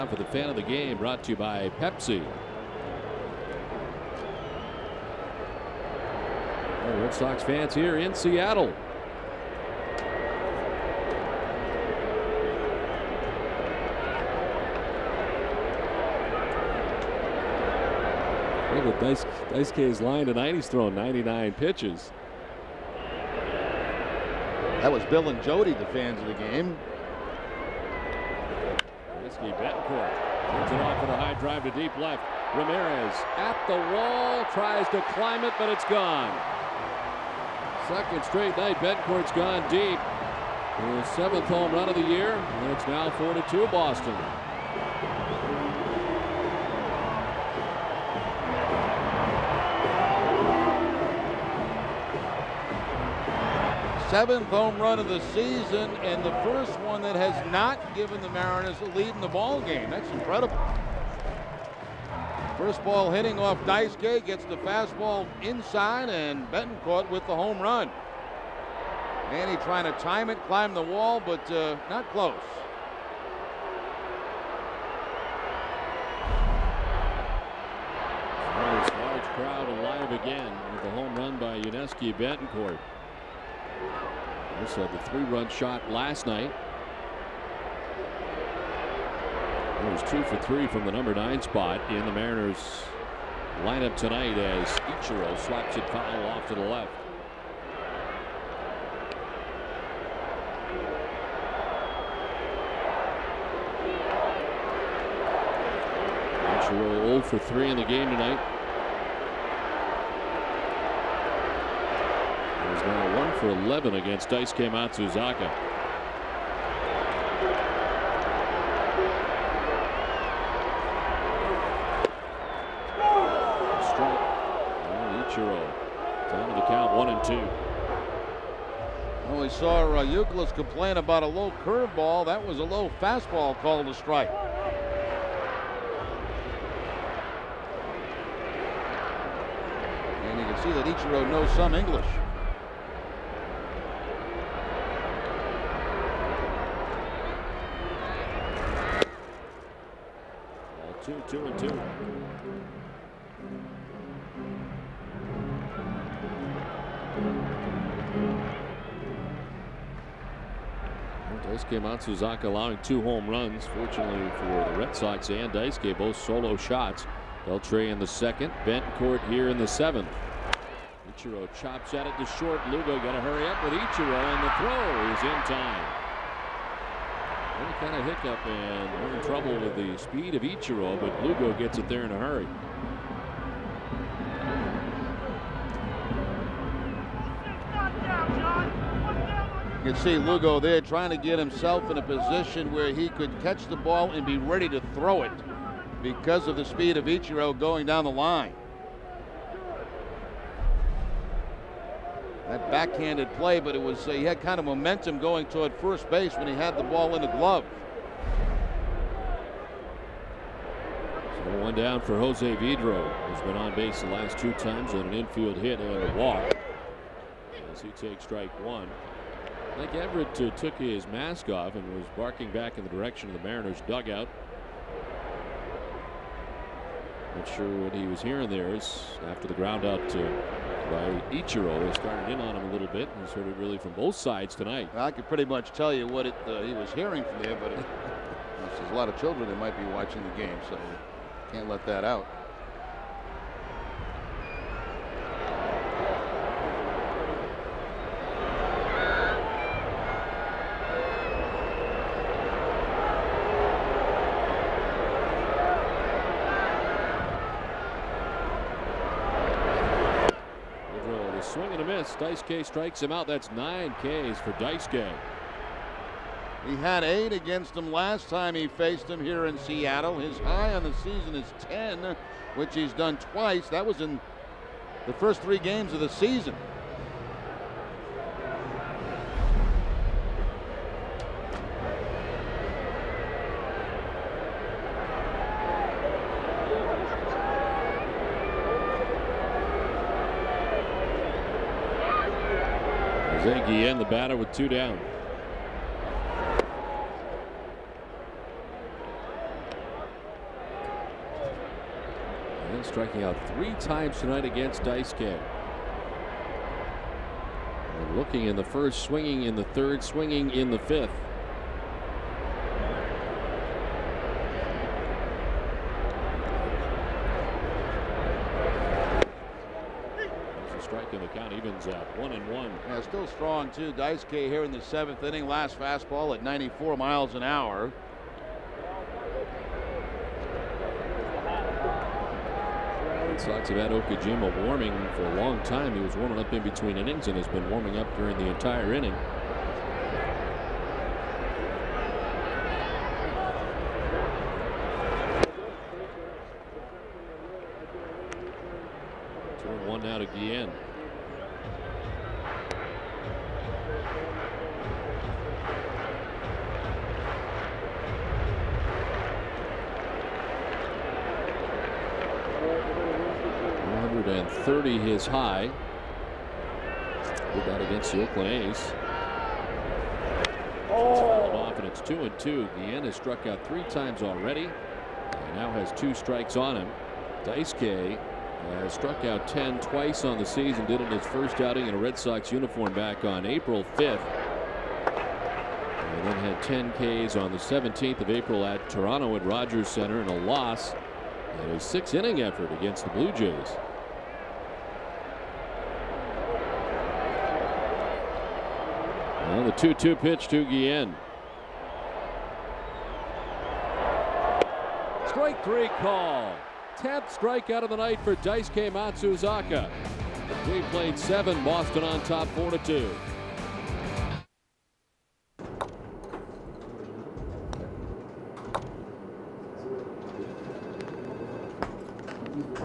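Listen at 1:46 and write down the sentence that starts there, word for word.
Ichiro 0 for 3 in the game tonight.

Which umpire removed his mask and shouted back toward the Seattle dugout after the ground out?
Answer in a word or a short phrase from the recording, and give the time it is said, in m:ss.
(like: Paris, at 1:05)
Mike Everitt, at 3:39.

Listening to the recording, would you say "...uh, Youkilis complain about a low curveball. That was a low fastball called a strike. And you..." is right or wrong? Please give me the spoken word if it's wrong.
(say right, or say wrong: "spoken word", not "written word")
right.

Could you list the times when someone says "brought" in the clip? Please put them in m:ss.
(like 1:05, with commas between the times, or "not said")
0:00.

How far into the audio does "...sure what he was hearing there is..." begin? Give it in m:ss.
3:47.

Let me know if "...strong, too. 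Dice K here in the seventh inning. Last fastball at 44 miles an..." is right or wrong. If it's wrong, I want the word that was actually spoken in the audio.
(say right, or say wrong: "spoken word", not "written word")
wrong: "94", not "44".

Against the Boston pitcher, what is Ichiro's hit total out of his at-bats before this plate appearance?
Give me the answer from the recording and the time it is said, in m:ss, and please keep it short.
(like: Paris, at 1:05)
1 for 11, at 1:53.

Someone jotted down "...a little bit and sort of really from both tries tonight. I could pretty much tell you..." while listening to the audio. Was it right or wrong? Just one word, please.
wrong.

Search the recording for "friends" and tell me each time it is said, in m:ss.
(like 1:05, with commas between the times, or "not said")
not said.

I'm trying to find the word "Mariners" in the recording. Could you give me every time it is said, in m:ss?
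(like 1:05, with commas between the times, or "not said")
0:58, 1:32, 3:43.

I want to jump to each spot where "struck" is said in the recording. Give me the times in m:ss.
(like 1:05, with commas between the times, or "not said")
6:13, 6:18.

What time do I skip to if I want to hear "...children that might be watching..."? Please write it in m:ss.
3:59.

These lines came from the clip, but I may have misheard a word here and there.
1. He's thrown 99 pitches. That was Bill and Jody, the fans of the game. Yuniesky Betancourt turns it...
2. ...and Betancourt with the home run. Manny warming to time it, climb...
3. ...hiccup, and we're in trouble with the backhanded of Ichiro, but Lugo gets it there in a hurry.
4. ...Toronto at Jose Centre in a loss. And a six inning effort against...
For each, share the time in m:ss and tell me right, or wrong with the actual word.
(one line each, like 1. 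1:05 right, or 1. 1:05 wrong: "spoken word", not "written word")
1. 0:20 right
2. 1:06 wrong: "trying", not "warming"
3. 2:58 wrong: "speed", not "backhanded"
4. 6:28 wrong: "Rogers", not "Jose".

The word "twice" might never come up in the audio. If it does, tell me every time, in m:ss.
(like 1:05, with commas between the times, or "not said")
4:33, 6:19.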